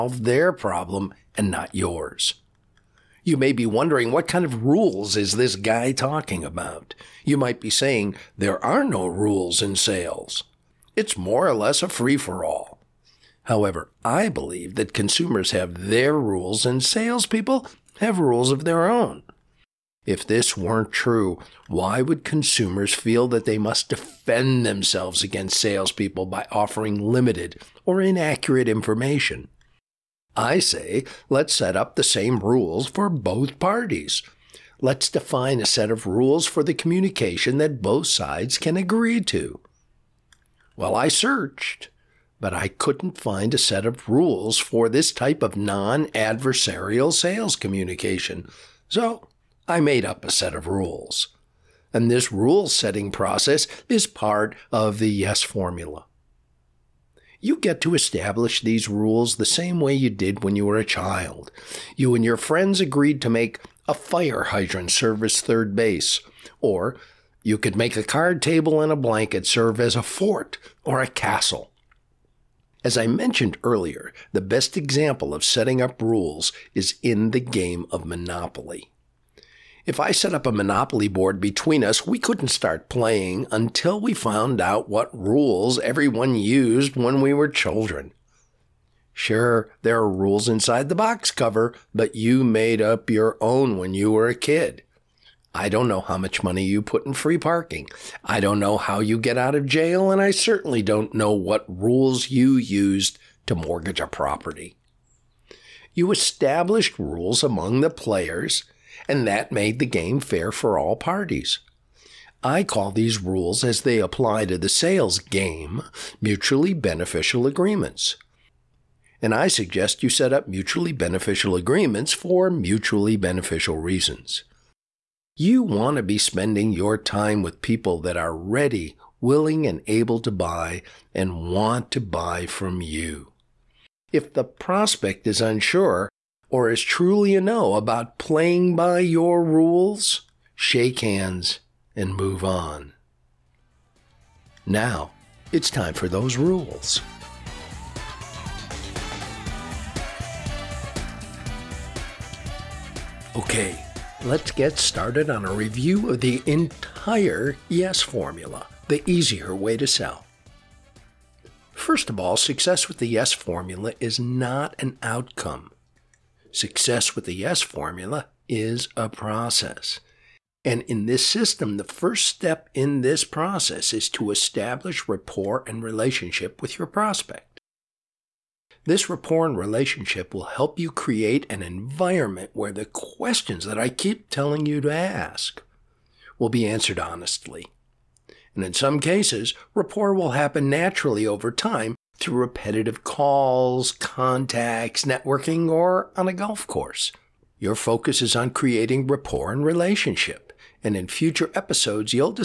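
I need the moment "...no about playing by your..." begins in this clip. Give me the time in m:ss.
2:17.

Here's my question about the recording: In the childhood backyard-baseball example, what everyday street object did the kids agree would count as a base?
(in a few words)
fire hydrant.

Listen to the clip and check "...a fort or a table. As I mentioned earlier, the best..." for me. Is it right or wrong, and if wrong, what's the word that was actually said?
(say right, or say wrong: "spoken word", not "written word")
wrong: "castle", not "table".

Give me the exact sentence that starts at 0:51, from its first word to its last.
And this rule setting process is part of the yes formula.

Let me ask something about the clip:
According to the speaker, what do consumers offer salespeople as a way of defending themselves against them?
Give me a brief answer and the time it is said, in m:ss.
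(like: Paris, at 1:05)
limited or inaccurate information, at 0:26.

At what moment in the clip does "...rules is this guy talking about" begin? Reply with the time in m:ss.
0:04.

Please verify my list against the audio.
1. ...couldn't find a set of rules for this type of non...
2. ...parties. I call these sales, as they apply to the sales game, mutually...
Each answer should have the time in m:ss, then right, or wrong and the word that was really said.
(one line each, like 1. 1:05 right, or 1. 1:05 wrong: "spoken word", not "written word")
1. 0:42 right
2. 1:50 wrong: "rules", not "sales".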